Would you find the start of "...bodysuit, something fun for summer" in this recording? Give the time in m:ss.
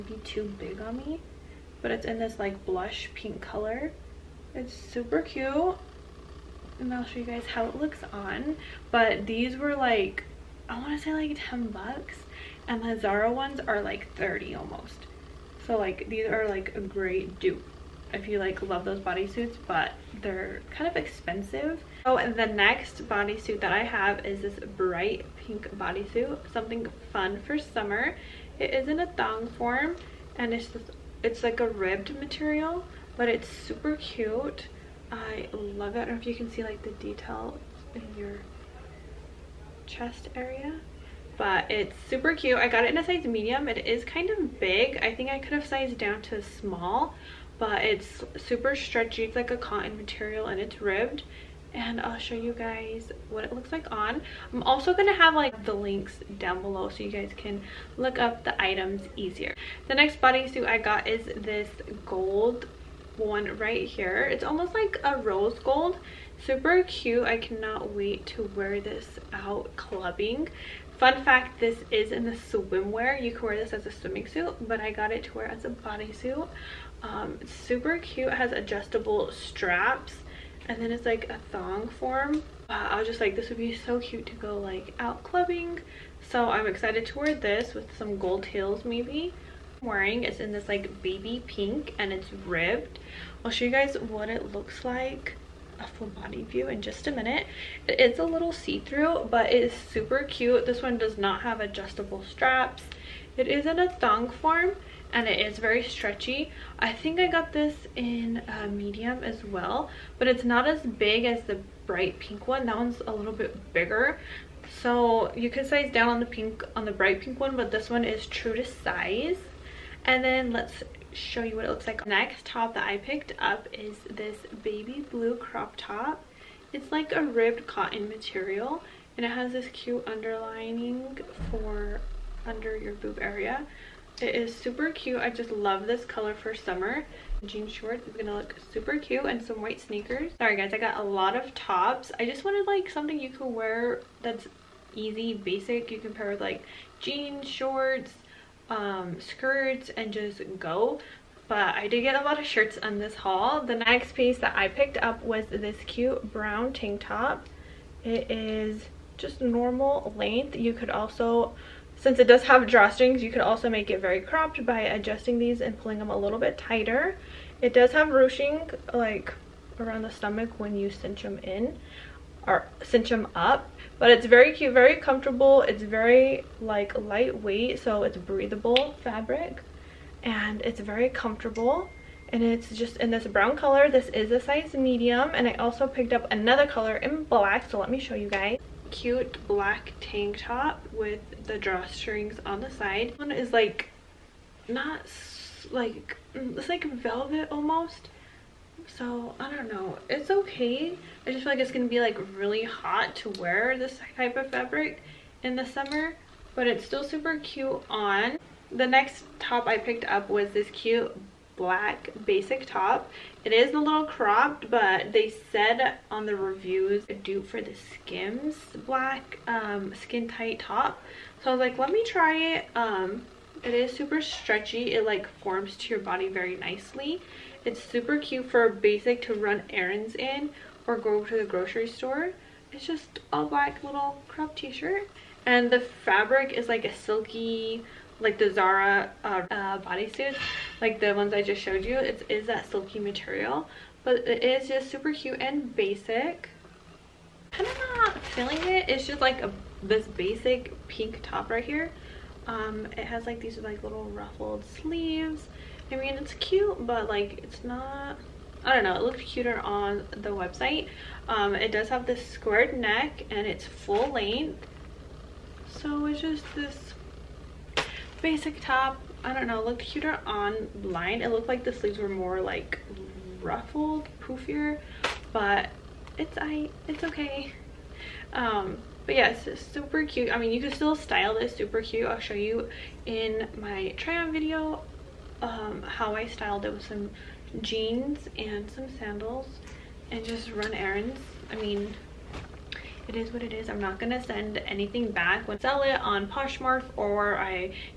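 0:25.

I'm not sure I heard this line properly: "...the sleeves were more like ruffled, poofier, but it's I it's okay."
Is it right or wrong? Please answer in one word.
right.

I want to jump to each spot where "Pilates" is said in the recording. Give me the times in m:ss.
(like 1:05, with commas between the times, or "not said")
not said.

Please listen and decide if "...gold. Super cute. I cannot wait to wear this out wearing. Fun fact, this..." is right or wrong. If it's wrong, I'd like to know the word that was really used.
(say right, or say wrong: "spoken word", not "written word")
wrong: "clubbing", not "wearing".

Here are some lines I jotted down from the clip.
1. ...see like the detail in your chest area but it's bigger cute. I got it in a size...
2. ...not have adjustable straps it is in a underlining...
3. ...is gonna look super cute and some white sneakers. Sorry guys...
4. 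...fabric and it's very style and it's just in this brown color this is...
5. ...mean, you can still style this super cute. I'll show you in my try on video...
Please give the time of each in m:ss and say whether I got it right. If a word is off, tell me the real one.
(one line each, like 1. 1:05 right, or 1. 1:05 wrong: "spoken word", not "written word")
1. 0:36 wrong: "super", not "bigger"
2. 1:41 wrong: "thong", not "underlining"
3. 2:18 right
4. 2:59 wrong: "comfortable", not "style"
5. 4:40 right.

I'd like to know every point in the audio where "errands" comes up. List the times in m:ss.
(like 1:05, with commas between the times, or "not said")
3:49, 4:50.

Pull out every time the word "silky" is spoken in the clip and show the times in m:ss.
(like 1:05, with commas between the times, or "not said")
3:56, 4:02.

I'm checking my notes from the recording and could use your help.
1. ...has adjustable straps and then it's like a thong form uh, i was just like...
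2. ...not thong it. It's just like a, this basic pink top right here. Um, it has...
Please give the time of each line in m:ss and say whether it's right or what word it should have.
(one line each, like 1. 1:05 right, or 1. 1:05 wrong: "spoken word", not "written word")
1. 1:18 right
2. 4:07 wrong: "feeling", not "thong".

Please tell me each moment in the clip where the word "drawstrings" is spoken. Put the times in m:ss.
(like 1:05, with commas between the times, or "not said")
2:42, 3:11.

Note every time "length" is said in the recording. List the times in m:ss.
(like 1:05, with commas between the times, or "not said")
2:40, 4:24.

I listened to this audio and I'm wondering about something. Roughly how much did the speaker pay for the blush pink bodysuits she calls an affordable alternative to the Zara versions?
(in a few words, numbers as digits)
10 bucks.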